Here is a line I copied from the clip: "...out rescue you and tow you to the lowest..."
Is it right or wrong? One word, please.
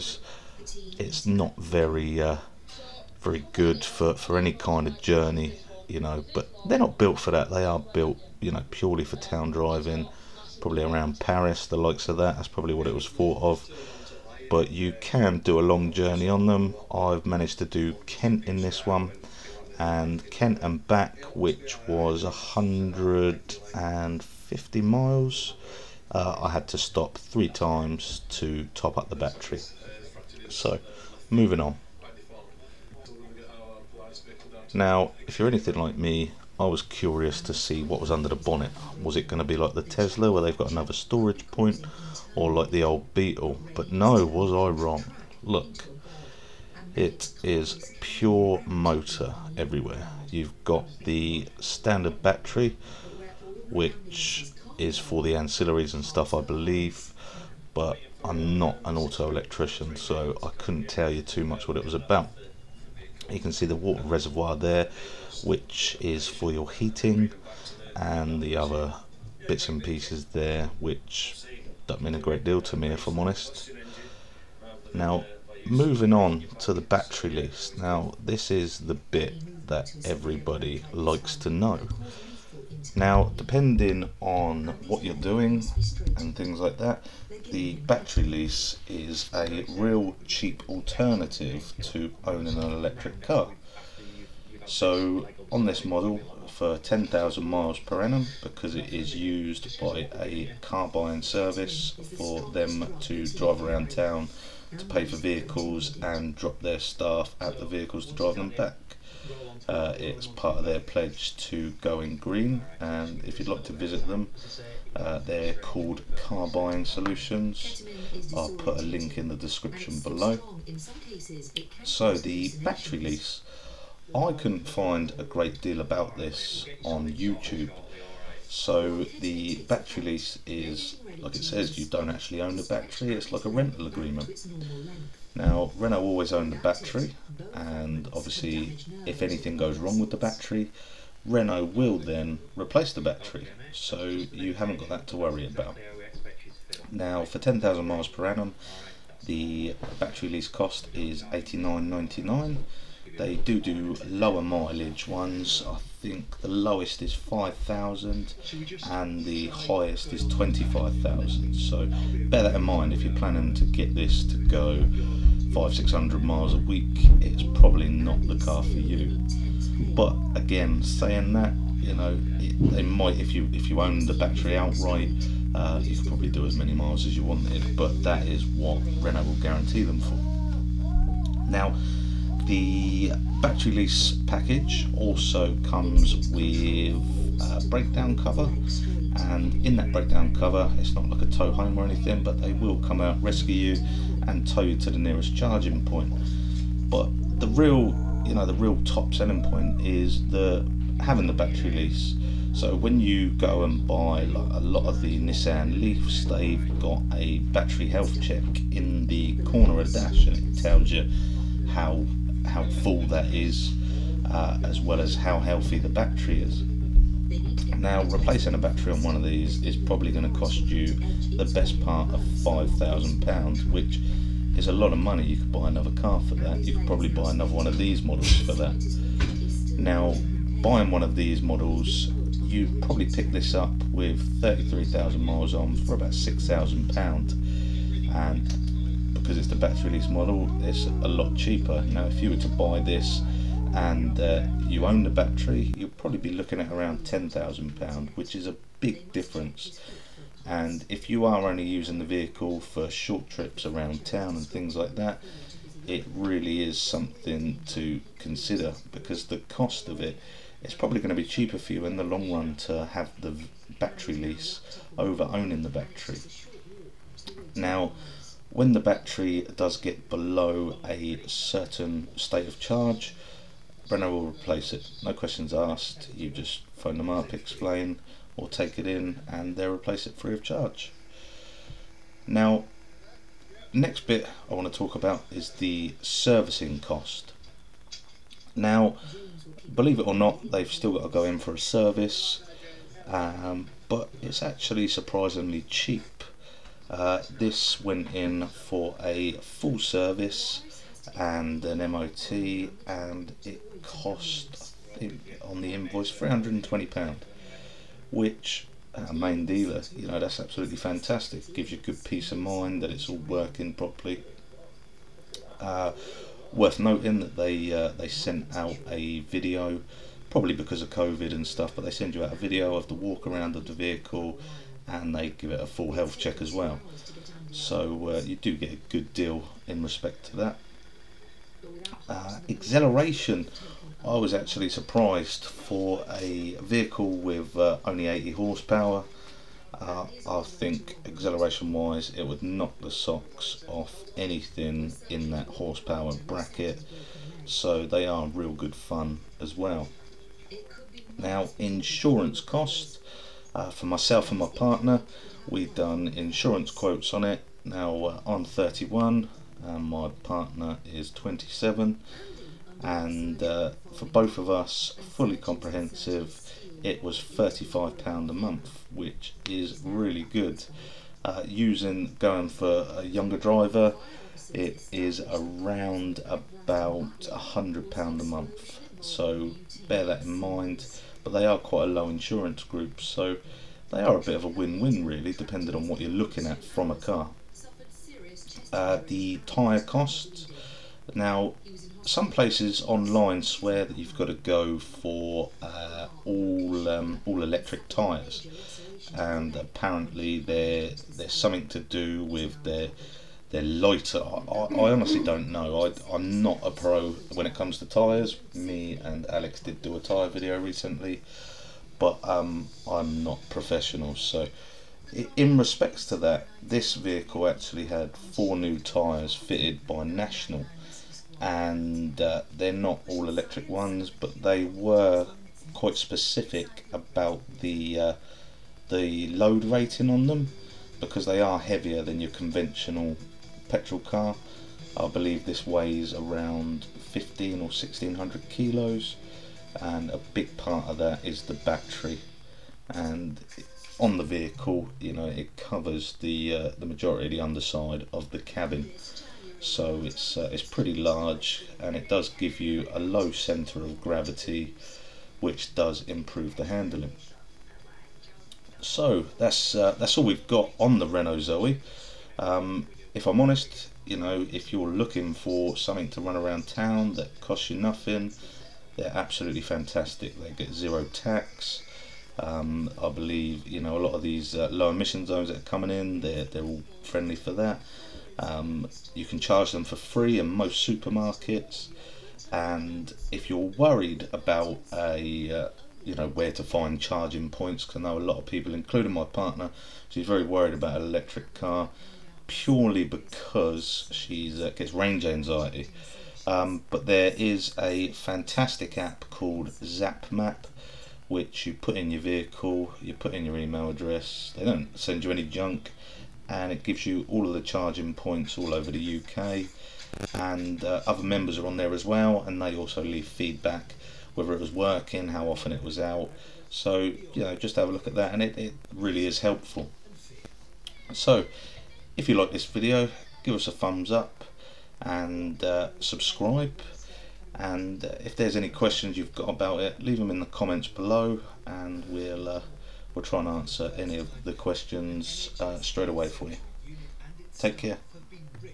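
wrong.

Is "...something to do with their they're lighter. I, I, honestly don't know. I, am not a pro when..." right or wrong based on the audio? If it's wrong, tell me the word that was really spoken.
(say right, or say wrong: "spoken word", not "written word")
right.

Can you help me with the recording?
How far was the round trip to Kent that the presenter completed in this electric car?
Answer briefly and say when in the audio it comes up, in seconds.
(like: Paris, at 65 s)
150 miles, at 22 s.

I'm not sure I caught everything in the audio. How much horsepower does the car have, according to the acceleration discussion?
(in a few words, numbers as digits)
80.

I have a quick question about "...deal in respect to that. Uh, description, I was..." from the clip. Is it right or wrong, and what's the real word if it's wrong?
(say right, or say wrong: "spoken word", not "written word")
wrong: "acceleration", not "description".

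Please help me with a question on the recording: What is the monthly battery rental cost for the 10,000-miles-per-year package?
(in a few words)
89.99.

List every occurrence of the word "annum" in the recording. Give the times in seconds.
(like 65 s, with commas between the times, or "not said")
98 s, 148 s.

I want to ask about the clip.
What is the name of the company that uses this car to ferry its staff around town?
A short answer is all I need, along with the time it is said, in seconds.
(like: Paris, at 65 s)
Car Buying Solutions, at 116 s.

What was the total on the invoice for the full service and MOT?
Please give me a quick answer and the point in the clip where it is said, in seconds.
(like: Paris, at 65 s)
£320, at 306 s.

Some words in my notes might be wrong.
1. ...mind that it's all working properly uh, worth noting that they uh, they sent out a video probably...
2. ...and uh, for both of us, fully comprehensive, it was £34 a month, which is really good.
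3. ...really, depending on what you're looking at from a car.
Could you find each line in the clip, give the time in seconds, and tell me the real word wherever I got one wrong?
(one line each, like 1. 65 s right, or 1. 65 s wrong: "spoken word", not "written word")
1. 312 s right
2. 362 s wrong: "35", not "34"
3. 385 s right.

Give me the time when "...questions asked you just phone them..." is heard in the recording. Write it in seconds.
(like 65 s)
275 s.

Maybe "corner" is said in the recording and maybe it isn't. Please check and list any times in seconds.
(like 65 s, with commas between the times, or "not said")
209 s.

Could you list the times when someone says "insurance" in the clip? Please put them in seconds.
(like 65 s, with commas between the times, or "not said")
351 s, 356 s, 382 s.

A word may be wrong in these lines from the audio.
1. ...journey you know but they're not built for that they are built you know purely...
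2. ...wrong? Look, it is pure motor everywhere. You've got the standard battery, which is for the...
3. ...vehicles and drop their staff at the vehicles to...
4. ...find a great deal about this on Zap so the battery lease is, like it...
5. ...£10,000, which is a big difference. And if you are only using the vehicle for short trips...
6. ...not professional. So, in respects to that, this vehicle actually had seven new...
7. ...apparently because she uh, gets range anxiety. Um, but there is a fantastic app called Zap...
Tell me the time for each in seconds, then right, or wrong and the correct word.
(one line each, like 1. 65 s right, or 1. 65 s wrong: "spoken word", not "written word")
1. 5 s right
2. 44 s right
3. 105 s right
4. 124 s wrong: "YouTube", not "Zap"
5. 246 s right
6. 413 s wrong: "four", not "seven"
7. 492 s wrong: "purely", not "apparently".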